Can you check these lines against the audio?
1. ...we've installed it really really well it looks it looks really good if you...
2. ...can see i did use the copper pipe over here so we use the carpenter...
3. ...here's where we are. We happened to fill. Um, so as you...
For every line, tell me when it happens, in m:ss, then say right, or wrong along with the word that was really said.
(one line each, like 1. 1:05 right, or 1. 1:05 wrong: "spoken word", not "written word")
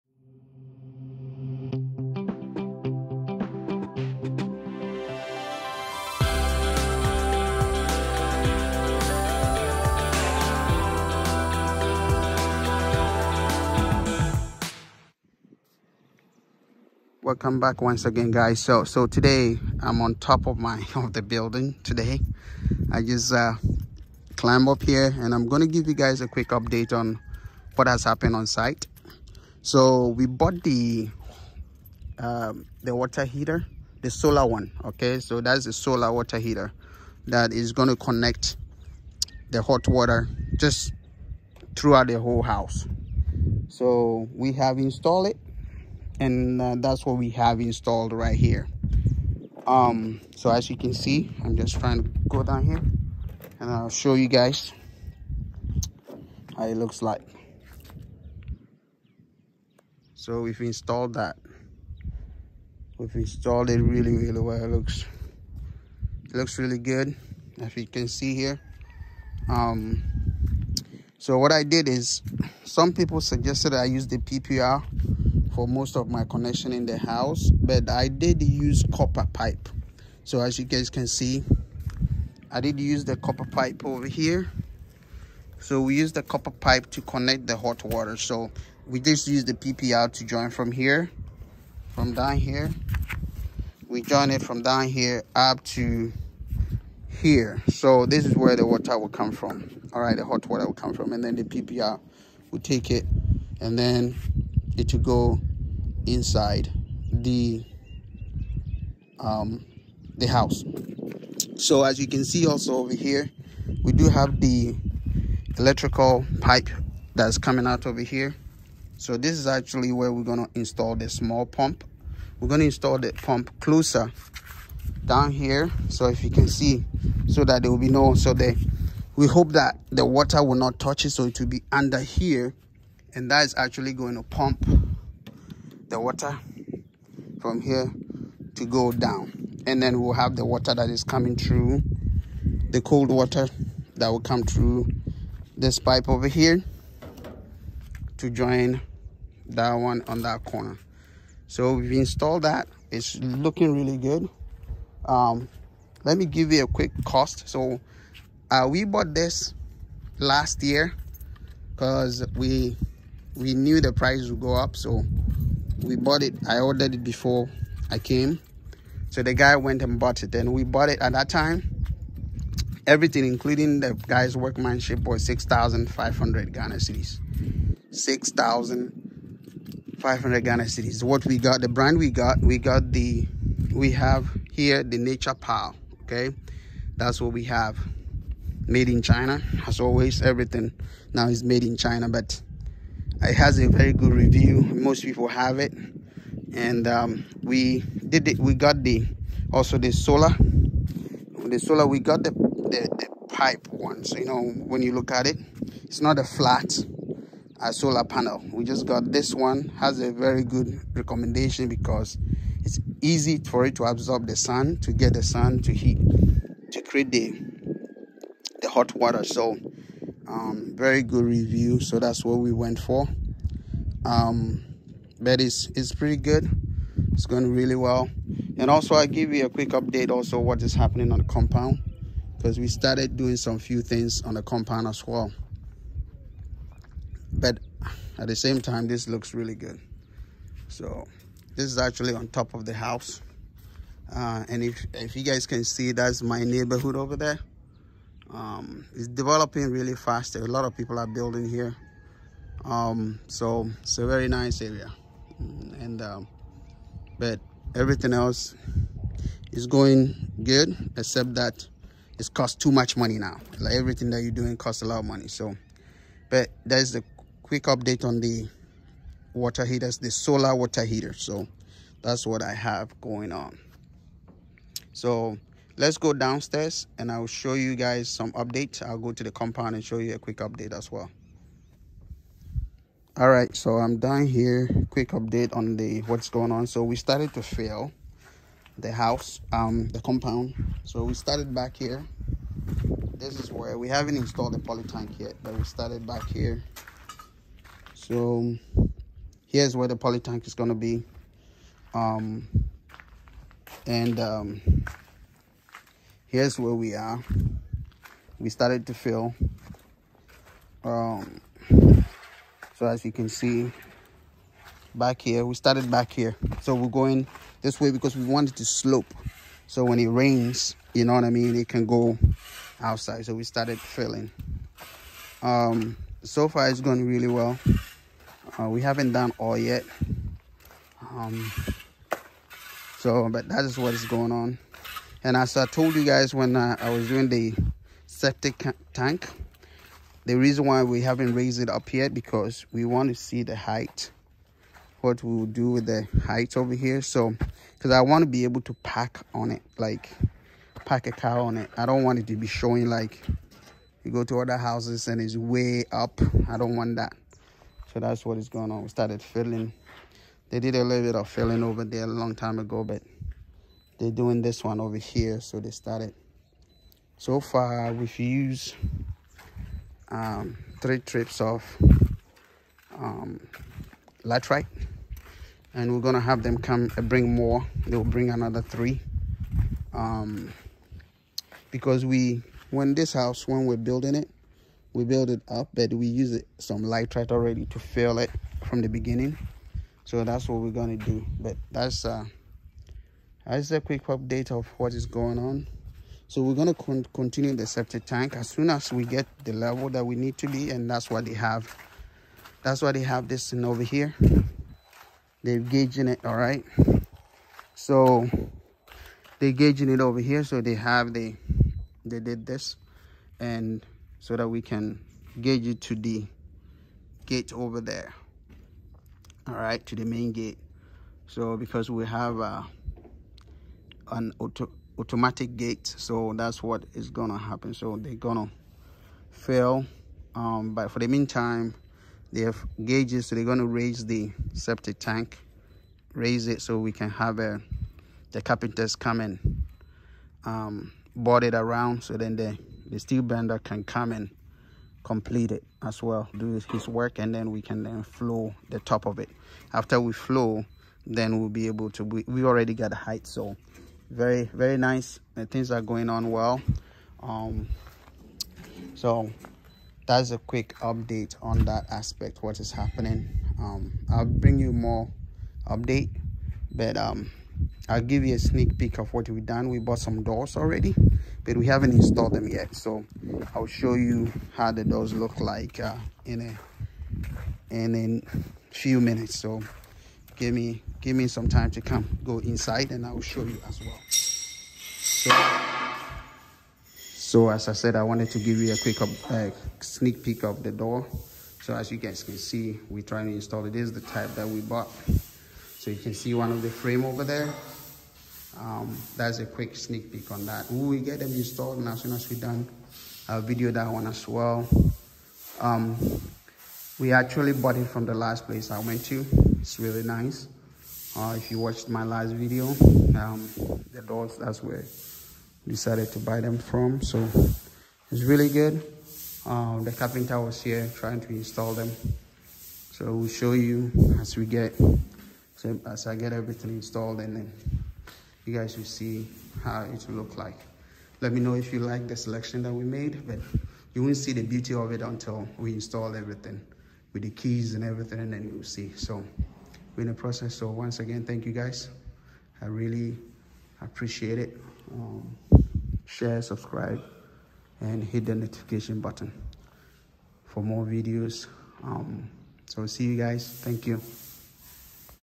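1. 1:02 right
2. 1:20 wrong: "copper", not "carpenter"
3. 5:06 wrong: "started", not "happened".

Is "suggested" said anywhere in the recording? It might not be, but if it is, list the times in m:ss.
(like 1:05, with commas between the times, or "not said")
1:13.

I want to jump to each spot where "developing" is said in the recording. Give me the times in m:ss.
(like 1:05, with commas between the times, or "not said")
4:09.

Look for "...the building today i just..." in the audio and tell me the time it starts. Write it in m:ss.
0:21.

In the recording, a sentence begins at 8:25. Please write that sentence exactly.
Um, we actually bought it from the last place I went to.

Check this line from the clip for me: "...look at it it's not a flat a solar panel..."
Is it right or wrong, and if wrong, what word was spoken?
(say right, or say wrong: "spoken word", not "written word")
right.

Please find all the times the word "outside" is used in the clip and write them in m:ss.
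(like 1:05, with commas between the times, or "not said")
5:22.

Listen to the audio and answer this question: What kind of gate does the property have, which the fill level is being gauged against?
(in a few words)
Automatic gate.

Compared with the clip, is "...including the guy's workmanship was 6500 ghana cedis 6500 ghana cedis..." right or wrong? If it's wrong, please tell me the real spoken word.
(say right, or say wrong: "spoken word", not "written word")
right.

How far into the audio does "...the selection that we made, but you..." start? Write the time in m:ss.
8:52.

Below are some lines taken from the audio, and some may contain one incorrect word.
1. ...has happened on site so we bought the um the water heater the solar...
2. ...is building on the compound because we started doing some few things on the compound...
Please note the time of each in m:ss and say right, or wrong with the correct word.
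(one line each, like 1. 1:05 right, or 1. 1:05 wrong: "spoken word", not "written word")
1. 0:27 right
2. 3:50 wrong: "happening", not "building".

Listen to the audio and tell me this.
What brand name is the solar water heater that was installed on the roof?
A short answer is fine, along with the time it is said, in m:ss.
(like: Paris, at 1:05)
Nature Power, at 3:04.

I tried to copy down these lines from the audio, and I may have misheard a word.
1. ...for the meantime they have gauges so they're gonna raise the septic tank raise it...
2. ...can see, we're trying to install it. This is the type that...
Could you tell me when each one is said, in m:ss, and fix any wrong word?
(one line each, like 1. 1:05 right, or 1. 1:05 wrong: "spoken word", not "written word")
1. 7:10 right
2. 8:12 right.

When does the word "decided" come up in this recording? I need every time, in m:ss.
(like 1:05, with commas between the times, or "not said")
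8:35.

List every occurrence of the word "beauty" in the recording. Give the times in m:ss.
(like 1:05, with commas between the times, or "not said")
8:54.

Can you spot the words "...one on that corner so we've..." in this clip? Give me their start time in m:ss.
2:29.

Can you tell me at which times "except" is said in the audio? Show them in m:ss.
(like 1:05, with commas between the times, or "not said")
4:20.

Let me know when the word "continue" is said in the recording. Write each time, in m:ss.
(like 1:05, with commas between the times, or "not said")
6:37.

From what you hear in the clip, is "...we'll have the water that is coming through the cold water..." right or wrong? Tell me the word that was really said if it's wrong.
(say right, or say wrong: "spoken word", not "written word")
right.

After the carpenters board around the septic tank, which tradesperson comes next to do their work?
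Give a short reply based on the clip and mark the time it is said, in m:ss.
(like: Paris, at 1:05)
Steel bender, at 7:22.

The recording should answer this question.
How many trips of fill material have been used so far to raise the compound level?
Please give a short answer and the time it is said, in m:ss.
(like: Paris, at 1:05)
3, at 6:10.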